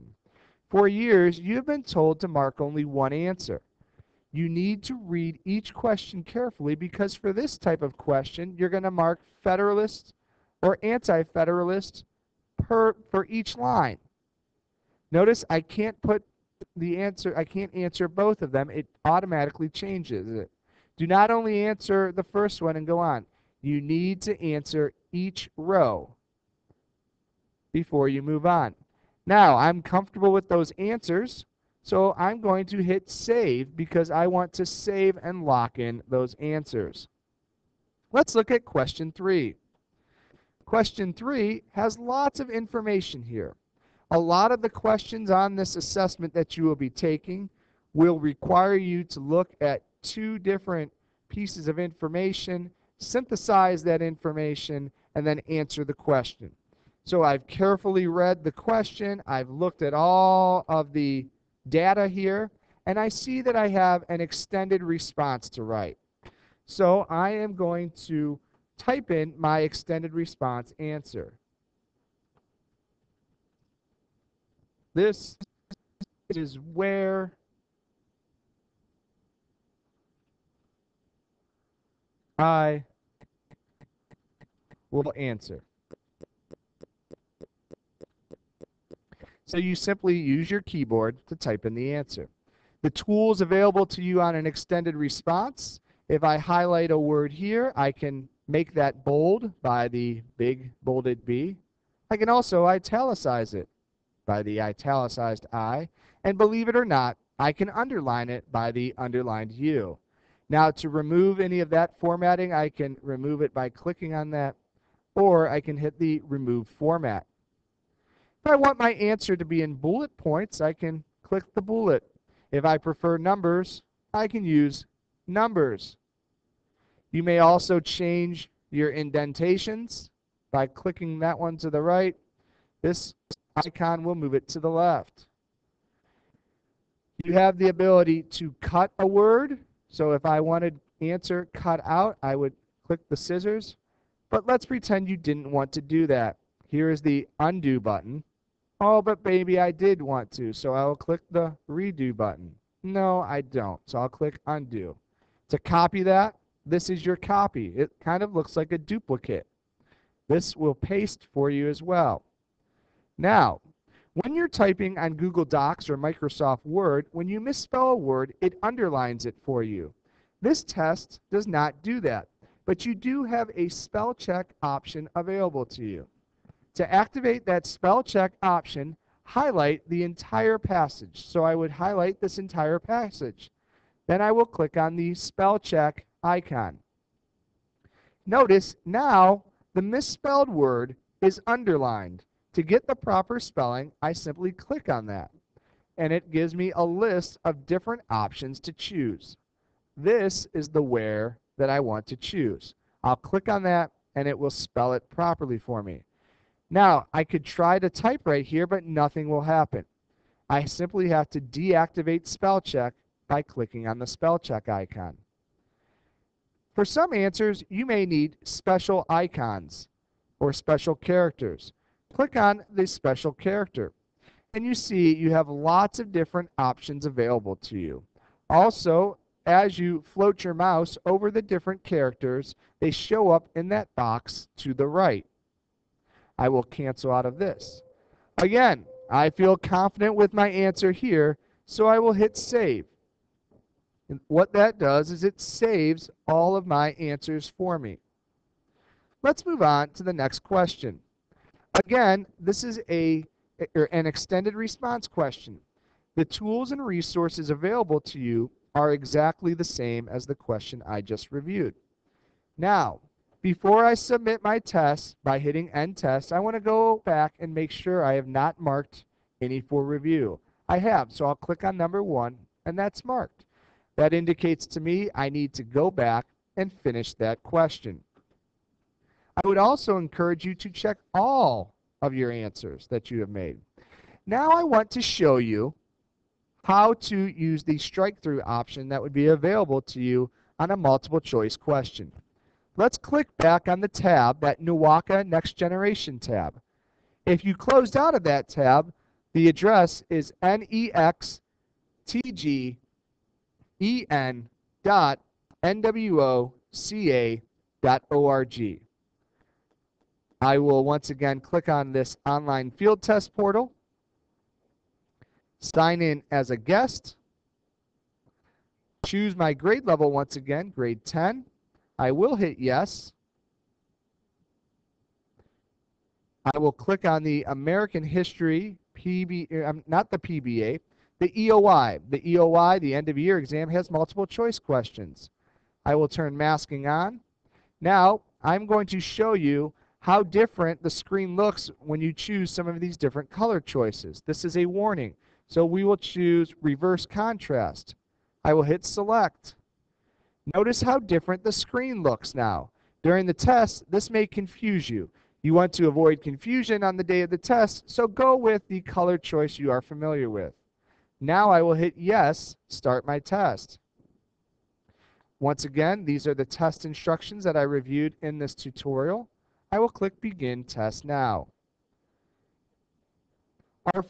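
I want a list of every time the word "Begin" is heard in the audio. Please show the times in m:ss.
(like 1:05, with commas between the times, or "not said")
6:10.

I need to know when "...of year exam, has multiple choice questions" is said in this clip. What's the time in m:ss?
5:33.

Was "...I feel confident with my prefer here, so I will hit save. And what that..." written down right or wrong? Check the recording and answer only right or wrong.
wrong.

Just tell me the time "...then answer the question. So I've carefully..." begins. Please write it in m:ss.
0:55.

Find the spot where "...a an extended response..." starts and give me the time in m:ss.
4:12.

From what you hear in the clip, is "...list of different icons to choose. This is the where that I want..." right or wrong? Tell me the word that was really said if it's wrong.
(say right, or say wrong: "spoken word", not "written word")
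wrong: "options", not "icons".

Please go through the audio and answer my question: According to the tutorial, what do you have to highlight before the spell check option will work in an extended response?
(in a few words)
the entire passage.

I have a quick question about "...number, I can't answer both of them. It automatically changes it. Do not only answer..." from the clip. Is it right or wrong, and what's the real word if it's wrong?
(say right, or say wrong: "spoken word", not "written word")
wrong: "answer", not "number".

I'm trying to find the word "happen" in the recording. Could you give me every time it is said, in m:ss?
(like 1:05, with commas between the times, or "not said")
3:29.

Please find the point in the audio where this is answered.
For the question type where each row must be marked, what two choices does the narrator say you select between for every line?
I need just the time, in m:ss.
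0:09.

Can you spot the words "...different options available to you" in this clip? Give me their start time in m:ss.
3:46.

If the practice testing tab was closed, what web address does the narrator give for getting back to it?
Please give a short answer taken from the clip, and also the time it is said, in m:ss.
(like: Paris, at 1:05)
nextgen.nwoca.org, at 5:00.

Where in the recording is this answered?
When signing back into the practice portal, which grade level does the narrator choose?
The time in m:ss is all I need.
5:20.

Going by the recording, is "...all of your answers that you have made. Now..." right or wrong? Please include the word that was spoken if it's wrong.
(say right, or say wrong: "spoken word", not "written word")
right.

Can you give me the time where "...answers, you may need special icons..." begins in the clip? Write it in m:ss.
3:37.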